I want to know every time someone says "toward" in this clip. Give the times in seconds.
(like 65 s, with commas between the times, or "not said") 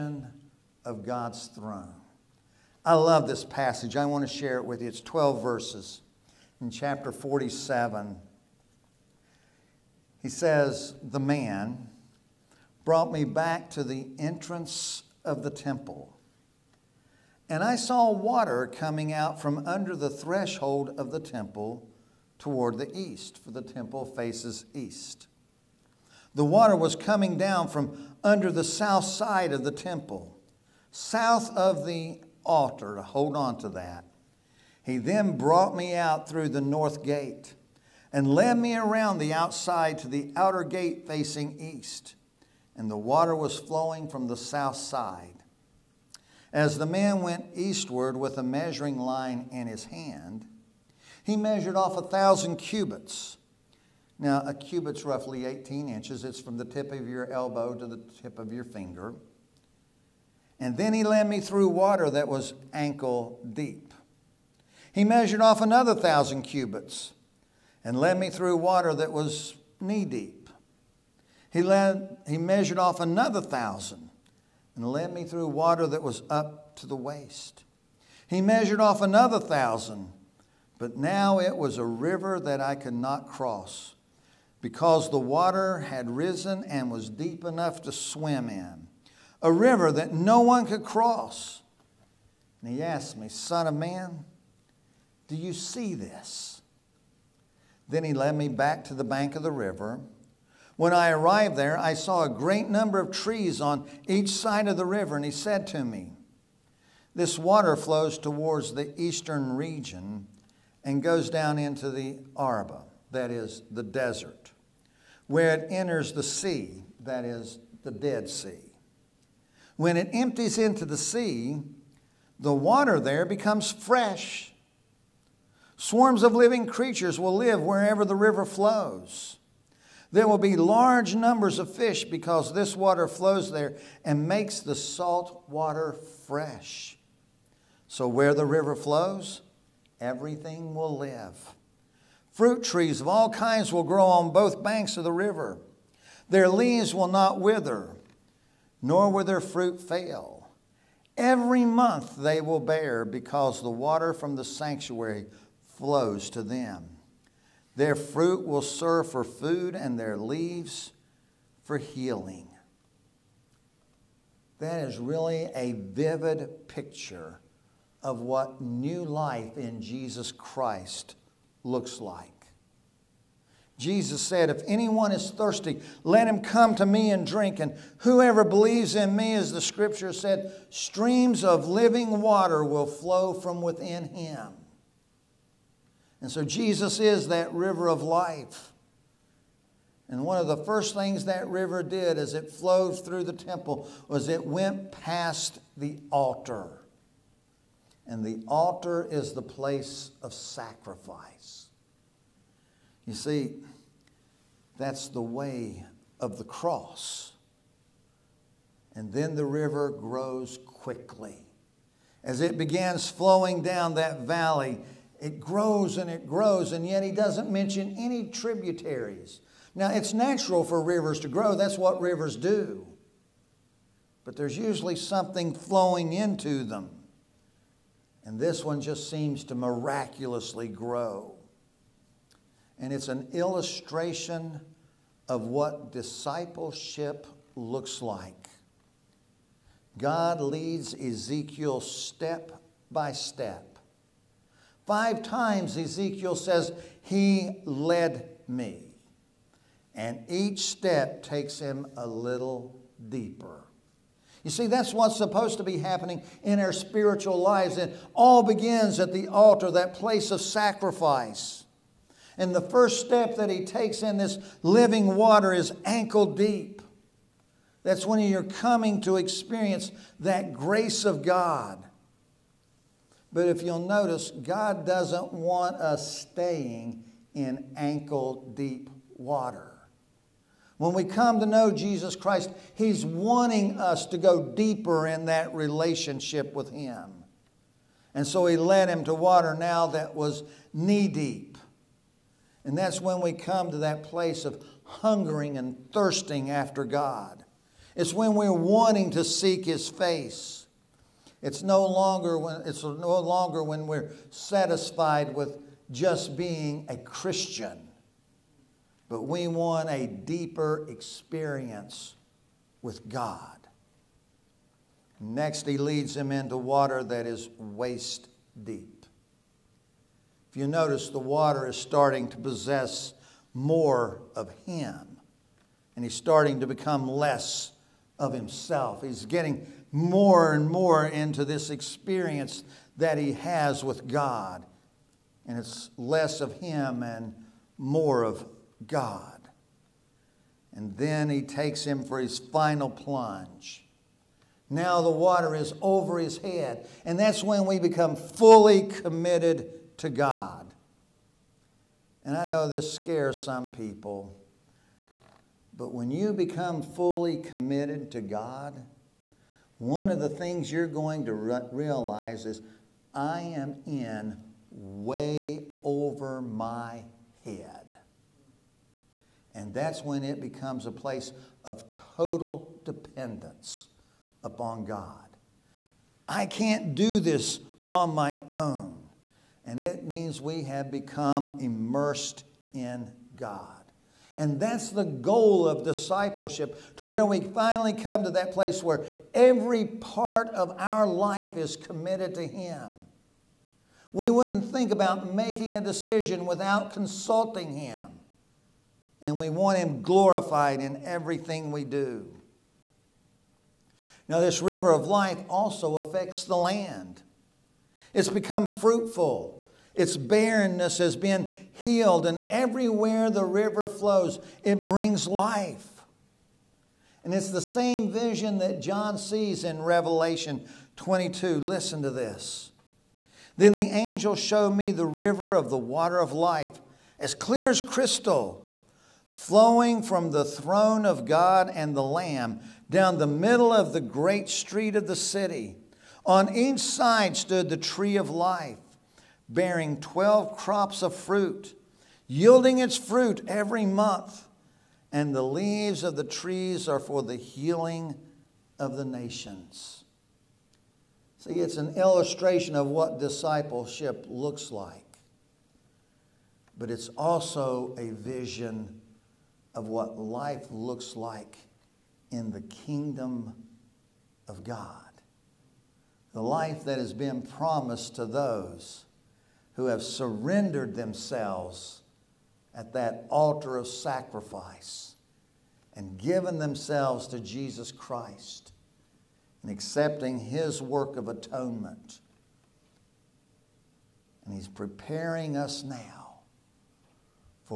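22 s, 108 s.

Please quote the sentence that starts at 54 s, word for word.
Now, a cubit's roughly 18 inches.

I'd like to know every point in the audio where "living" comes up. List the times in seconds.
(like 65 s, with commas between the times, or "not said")
126 s, 181 s, 264 s.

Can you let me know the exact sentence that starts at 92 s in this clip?
And he asked me, Son of man, do you see this?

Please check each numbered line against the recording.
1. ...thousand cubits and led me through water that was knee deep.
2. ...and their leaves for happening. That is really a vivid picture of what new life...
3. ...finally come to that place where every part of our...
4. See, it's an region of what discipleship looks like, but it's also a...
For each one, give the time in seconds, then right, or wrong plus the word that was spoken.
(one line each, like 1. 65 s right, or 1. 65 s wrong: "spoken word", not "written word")
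1. 65 s right
2. 159 s wrong: "healing", not "happening"
3. 387 s right
4. 451 s wrong: "illustration", not "region".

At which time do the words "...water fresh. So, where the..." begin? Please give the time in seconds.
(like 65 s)
135 s.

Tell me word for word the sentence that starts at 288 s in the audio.
And so He led him to water now that was knee deep.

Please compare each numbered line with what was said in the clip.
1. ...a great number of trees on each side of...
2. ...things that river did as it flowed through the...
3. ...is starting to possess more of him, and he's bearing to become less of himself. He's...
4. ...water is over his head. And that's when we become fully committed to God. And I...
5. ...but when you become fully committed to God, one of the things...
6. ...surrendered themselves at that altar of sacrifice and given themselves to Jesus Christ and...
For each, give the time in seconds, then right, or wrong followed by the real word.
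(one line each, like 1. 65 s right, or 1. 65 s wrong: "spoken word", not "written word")
1. 102 s right
2. 190 s right
3. 321 s wrong: "starting", not "bearing"
4. 345 s right
5. 355 s right
6. 470 s right.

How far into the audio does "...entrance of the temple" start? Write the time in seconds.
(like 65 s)
14 s.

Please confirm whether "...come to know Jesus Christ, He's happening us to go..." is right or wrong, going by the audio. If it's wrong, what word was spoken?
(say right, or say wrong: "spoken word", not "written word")
wrong: "wanting", not "happening".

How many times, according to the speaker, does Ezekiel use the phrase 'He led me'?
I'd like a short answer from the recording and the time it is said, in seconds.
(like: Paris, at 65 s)
5, at 244 s.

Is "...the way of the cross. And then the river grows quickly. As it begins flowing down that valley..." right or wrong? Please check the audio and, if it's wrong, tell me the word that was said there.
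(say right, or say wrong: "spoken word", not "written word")
right.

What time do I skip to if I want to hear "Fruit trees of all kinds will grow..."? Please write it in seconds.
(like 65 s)
142 s.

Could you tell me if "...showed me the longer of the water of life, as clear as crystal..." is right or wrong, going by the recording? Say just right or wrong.
wrong.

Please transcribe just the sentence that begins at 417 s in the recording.
And it's the same vision that John sees in Revelation 22.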